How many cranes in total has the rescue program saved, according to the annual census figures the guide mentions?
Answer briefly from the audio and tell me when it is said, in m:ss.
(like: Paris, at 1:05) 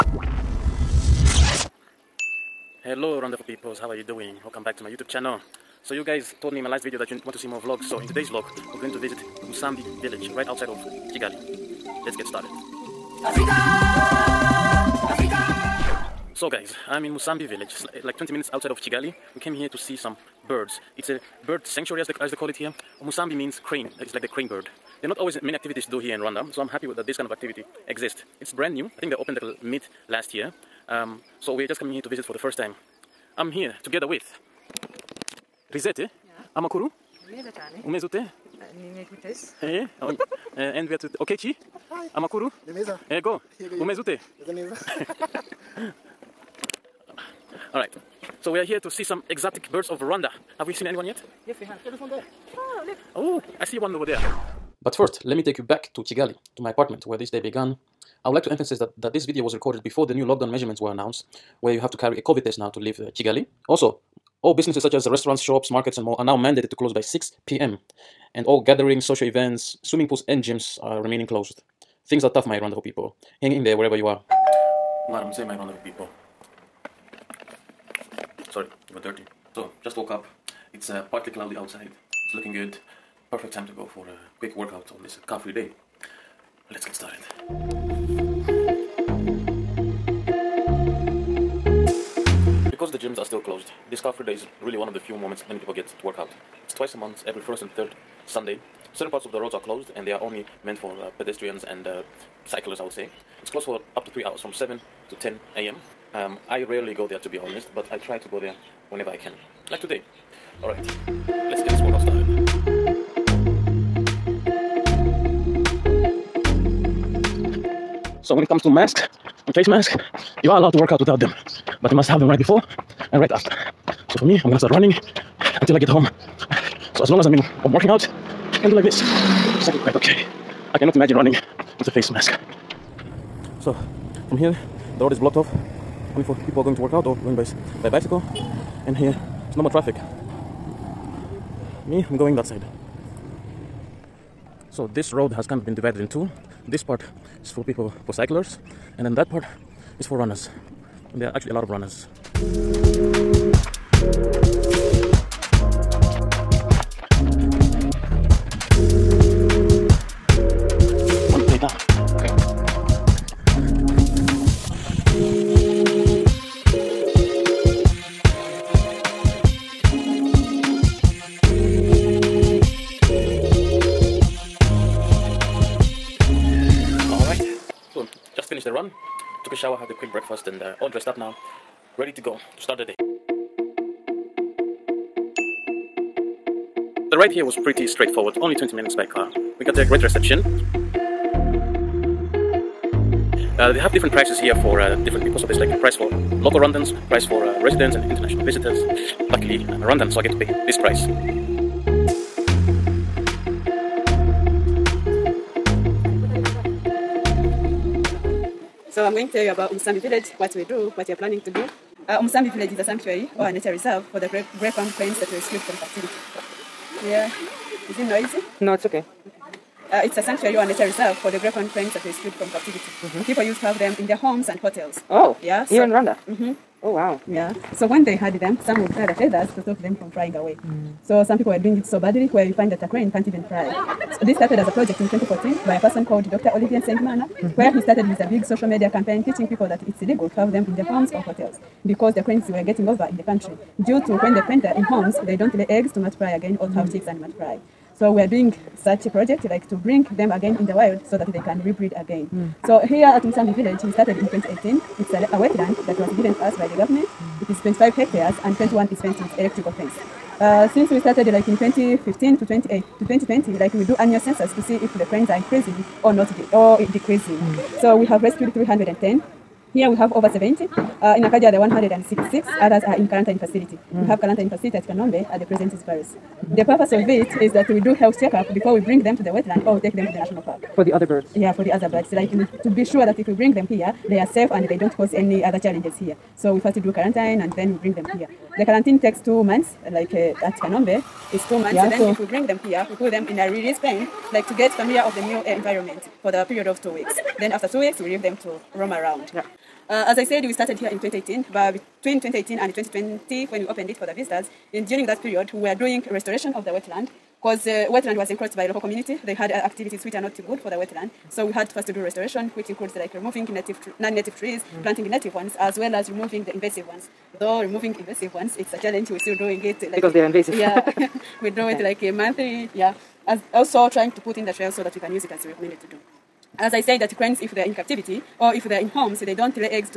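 310, at 4:28.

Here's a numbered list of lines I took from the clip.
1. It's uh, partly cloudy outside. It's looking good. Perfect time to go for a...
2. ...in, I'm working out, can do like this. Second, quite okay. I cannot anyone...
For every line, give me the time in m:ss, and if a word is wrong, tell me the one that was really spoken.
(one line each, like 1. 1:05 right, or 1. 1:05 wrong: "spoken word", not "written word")
1. 1:20 right
2. 2:07 wrong: "imagine", not "anyone".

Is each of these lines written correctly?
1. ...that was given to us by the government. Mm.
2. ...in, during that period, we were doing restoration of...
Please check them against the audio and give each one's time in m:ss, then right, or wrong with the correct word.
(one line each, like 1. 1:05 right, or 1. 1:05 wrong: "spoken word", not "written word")
1. 4:15 right
2. 5:04 right.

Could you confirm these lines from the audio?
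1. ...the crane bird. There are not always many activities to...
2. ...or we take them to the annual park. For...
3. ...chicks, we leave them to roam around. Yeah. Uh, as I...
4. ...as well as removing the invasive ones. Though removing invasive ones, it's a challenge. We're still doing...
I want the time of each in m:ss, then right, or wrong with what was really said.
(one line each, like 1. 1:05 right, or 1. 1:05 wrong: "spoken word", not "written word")
1. 0:24 right
2. 4:39 wrong: "national", not "annual"
3. 4:57 wrong: "weeks", not "chicks"
4. 5:15 right.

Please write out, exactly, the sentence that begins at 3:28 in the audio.
So I'm going to tell you about Musambi village, what we do, what we are planning to do.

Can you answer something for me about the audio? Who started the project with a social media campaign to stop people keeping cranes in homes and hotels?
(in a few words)
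Dr. Olivier Nsengimana.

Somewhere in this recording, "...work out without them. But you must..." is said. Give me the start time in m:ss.
2:00.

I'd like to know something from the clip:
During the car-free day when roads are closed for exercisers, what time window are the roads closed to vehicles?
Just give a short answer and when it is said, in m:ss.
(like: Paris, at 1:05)
7 to 10 a.m., at 1:44.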